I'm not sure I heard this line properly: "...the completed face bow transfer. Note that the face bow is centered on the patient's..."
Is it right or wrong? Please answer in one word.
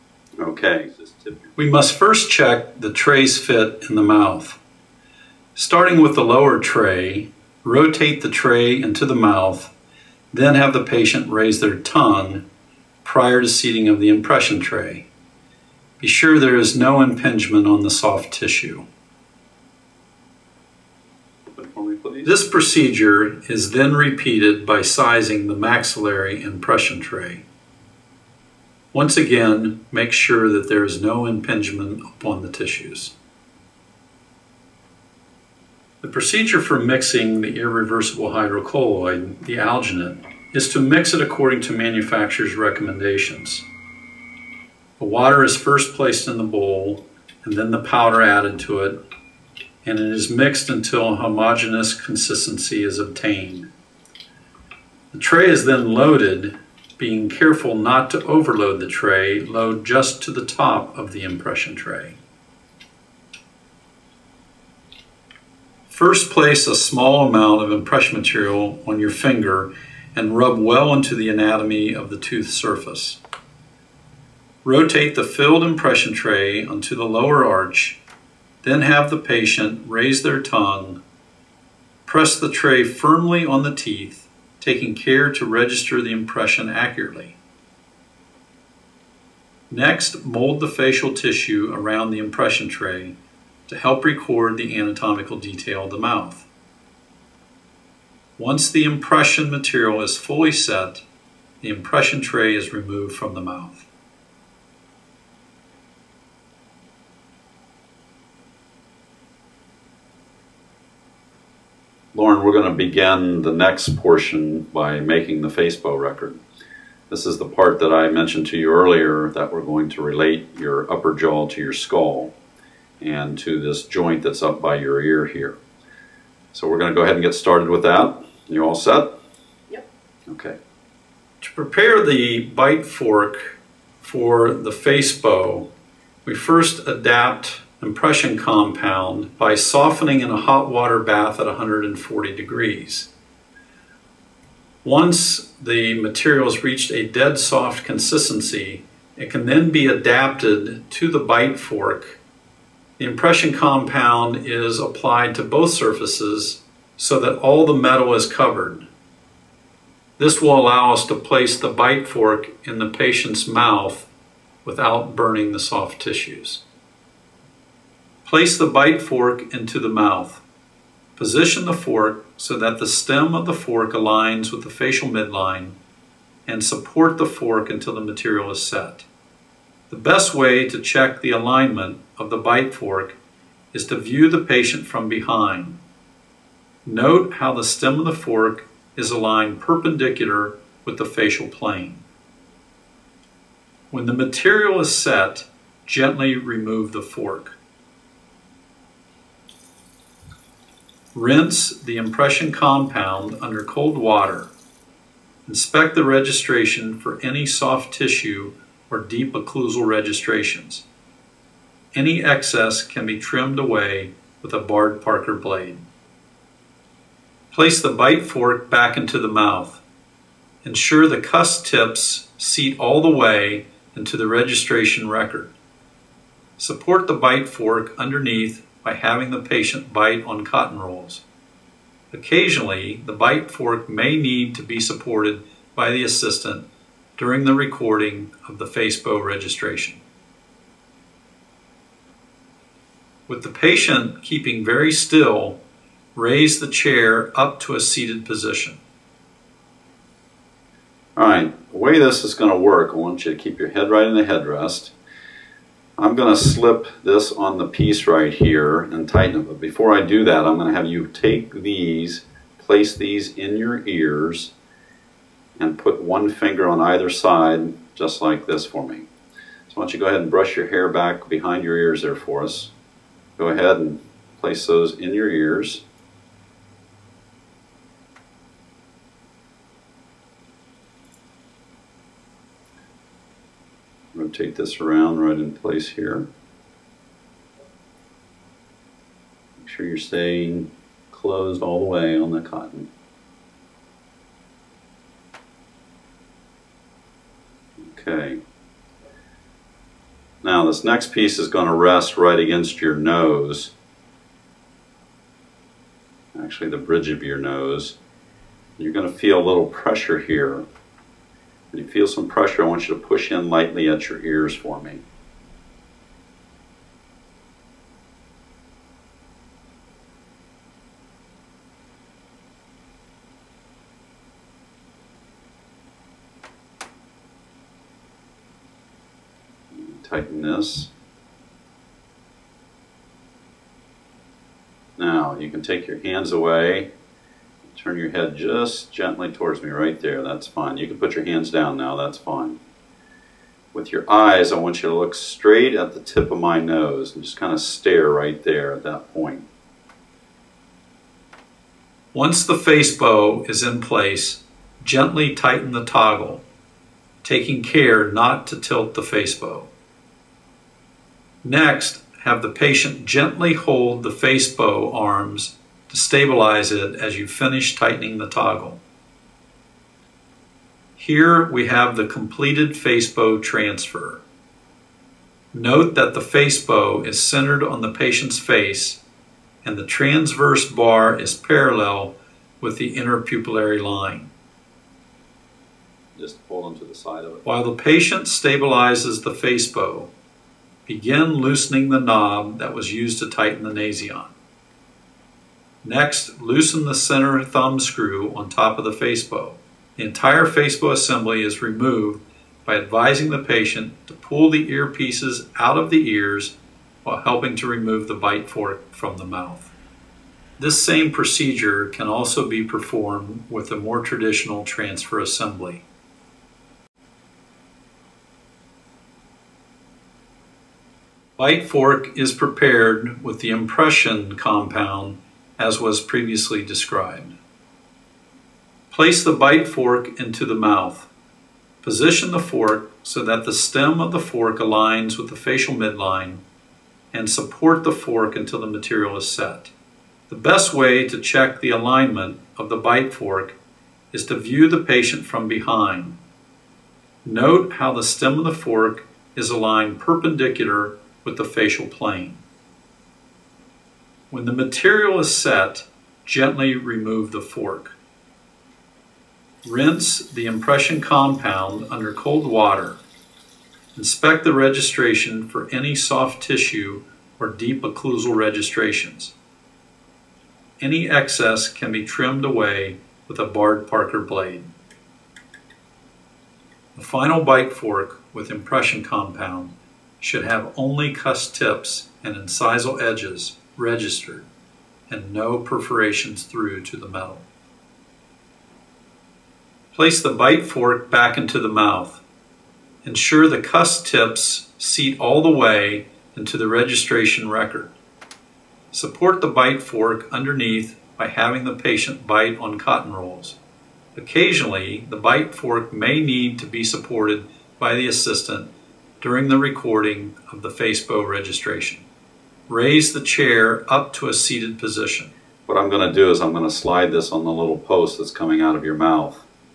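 right.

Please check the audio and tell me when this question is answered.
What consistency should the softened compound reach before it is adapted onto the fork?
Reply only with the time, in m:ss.
2:27.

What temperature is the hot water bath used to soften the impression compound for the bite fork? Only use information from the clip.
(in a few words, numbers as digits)
140 degrees.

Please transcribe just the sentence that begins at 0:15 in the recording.
Be sure there is no impingement on the soft tissue.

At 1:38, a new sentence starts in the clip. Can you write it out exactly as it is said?
Once the impression material is fully set, the impression tray is removed from the mouth.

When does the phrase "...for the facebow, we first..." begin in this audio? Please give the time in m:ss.
2:14.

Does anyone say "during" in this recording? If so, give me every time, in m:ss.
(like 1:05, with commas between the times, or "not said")
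3:57, 8:29.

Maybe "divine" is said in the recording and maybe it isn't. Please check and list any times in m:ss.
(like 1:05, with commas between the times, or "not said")
not said.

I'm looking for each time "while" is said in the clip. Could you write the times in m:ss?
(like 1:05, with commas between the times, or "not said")
6:27, 6:47.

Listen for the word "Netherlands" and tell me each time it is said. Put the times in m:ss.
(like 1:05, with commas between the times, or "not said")
not said.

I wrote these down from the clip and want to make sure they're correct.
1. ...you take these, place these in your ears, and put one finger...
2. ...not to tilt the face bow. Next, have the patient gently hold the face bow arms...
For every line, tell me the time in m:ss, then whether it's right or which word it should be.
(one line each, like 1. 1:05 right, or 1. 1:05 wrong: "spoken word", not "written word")
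1. 4:20 right
2. 5:58 right.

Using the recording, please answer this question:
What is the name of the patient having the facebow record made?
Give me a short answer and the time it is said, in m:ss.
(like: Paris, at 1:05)
Lauren, at 1:52.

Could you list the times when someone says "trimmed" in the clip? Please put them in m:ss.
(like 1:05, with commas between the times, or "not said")
3:33, 7:52.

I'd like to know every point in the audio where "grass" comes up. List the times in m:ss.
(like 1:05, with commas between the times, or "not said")
not said.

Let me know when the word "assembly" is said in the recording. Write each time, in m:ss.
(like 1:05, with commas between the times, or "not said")
6:40, 6:55.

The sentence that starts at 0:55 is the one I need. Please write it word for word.
The tray is then loaded being careful not to overload the tray, load just to the top of the impression tray.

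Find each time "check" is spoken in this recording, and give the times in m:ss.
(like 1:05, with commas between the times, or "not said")
0:02, 3:00, 7:21.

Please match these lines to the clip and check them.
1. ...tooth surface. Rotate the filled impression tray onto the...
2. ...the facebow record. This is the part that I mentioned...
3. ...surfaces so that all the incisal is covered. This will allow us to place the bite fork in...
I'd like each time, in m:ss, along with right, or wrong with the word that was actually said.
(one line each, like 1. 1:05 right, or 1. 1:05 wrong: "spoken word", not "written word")
1. 1:12 right
2. 1:55 right
3. 2:35 wrong: "metal", not "incisal".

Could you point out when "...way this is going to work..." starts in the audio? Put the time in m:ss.
4:11.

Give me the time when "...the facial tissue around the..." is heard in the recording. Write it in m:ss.
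1:30.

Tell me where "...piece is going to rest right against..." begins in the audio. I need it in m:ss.
5:01.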